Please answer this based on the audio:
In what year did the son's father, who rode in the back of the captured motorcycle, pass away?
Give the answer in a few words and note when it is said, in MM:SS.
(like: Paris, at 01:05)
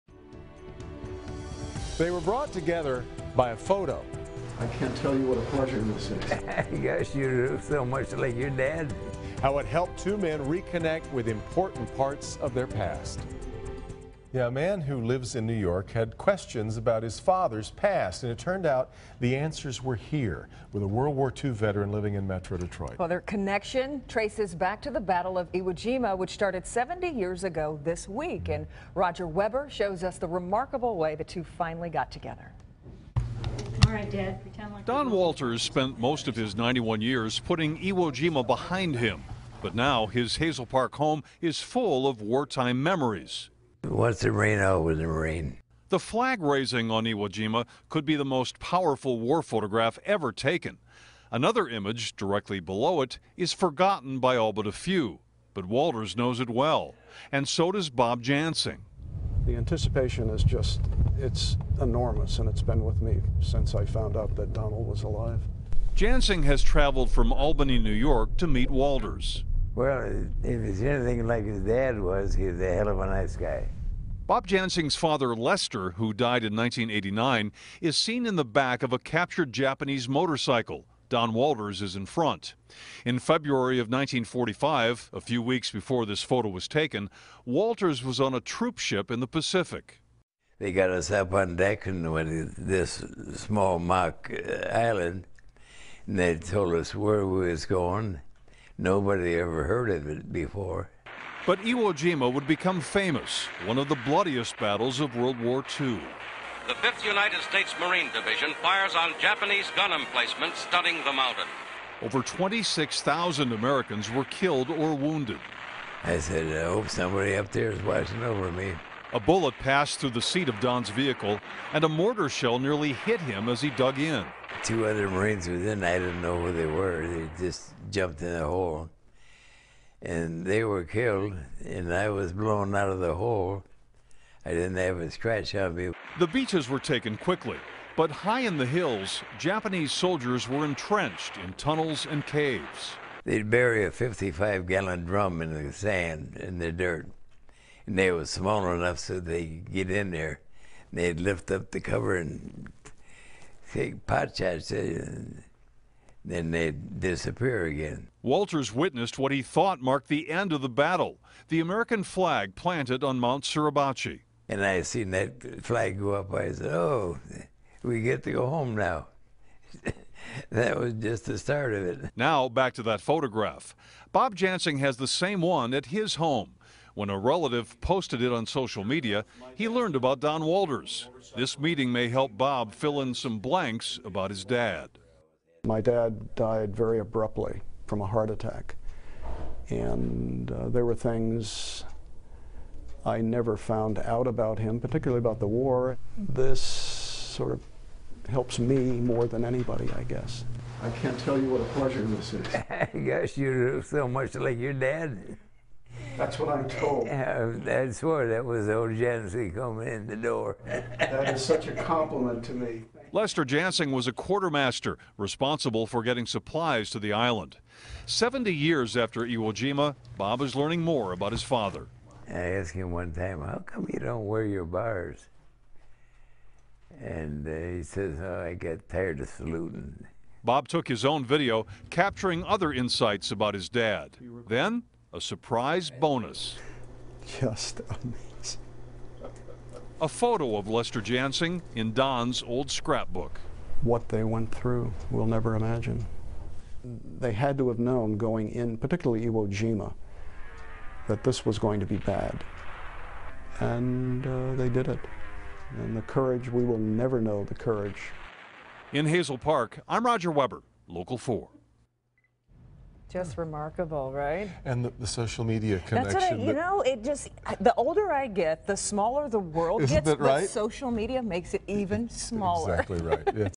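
1989, at 01:16.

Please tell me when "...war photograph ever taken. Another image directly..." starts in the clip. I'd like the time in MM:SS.
00:49.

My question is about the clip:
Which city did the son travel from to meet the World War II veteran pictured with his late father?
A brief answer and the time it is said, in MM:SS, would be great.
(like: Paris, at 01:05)
Albany, New York, at 01:07.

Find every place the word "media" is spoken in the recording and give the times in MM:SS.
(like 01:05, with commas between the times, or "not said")
02:58, 04:25, 04:30.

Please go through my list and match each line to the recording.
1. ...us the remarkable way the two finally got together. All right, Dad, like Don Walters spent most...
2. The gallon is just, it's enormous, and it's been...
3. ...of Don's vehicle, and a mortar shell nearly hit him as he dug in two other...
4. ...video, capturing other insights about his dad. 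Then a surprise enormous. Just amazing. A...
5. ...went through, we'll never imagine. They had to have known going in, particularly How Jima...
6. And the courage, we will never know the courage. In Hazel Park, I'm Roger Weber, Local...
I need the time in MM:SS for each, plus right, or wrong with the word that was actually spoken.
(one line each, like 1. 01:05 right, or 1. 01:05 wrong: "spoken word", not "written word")
1. 00:30 right
2. 00:59 wrong: "anticipation", not "gallon"
3. 02:00 right
4. 03:51 wrong: "bonus", not "enormous"
5. 04:04 wrong: "Iwo", not "How"
6. 04:15 right.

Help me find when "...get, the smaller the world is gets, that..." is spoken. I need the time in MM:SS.
04:28.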